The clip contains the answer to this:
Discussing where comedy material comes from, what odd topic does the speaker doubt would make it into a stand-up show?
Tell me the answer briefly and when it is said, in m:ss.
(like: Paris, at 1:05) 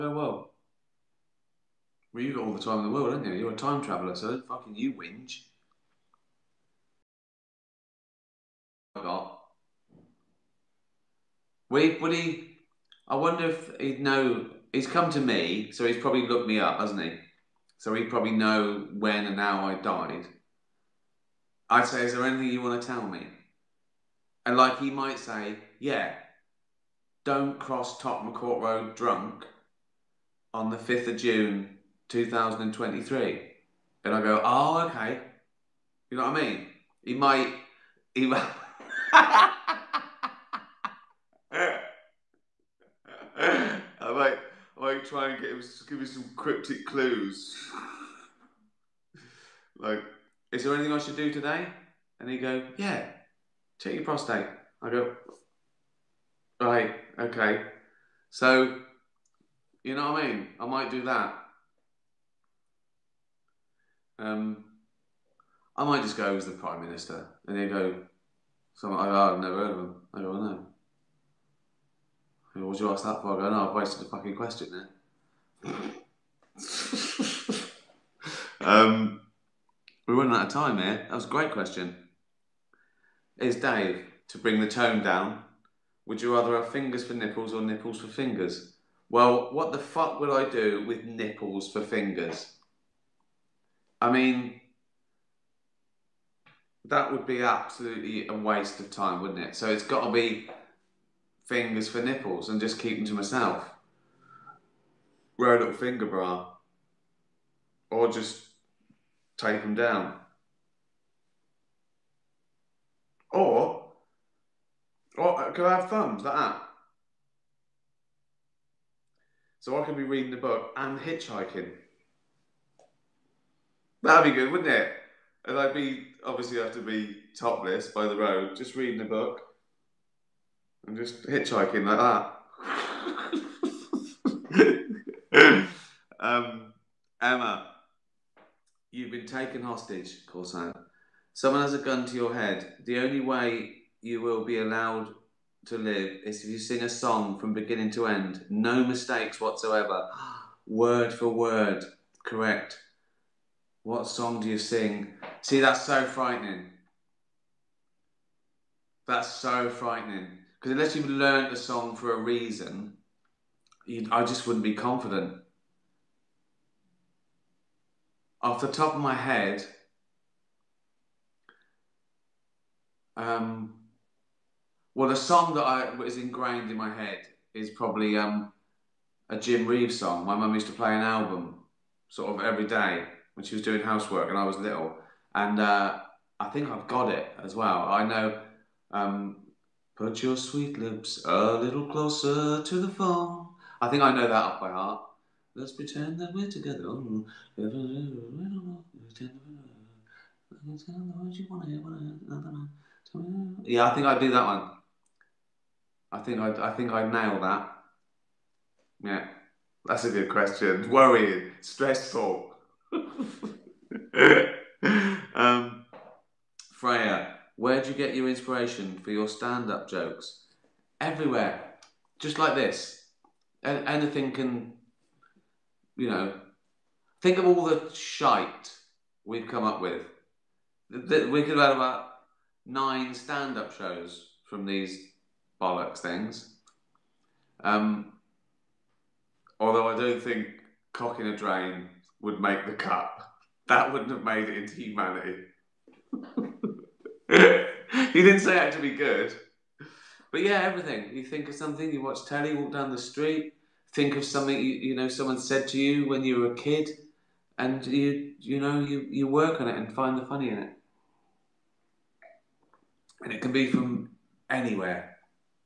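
Cocking a drain, at 4:00.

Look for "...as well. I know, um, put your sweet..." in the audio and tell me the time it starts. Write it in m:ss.
3:07.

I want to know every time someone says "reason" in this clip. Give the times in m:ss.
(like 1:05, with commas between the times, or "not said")
2:42.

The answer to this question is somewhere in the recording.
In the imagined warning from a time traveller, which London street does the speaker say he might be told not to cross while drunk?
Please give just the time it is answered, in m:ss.
0:27.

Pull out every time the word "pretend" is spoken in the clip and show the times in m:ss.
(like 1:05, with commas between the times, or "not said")
3:15.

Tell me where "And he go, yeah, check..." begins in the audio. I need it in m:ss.
0:52.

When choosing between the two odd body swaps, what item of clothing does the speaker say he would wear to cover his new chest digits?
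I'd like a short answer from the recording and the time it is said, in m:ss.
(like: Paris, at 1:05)
Finger bra, at 1:45.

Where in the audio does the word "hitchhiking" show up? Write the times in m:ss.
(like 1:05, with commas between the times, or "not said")
2:01, 2:11.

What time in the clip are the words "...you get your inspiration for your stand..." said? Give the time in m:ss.
3:37.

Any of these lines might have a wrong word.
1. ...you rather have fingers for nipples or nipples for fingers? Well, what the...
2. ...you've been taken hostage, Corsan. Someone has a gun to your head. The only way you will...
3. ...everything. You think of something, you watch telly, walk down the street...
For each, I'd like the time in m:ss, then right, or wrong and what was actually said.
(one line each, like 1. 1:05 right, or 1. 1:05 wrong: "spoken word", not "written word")
1. 1:26 right
2. 2:18 right
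3. 4:10 right.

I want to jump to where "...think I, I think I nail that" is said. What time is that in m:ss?
3:26.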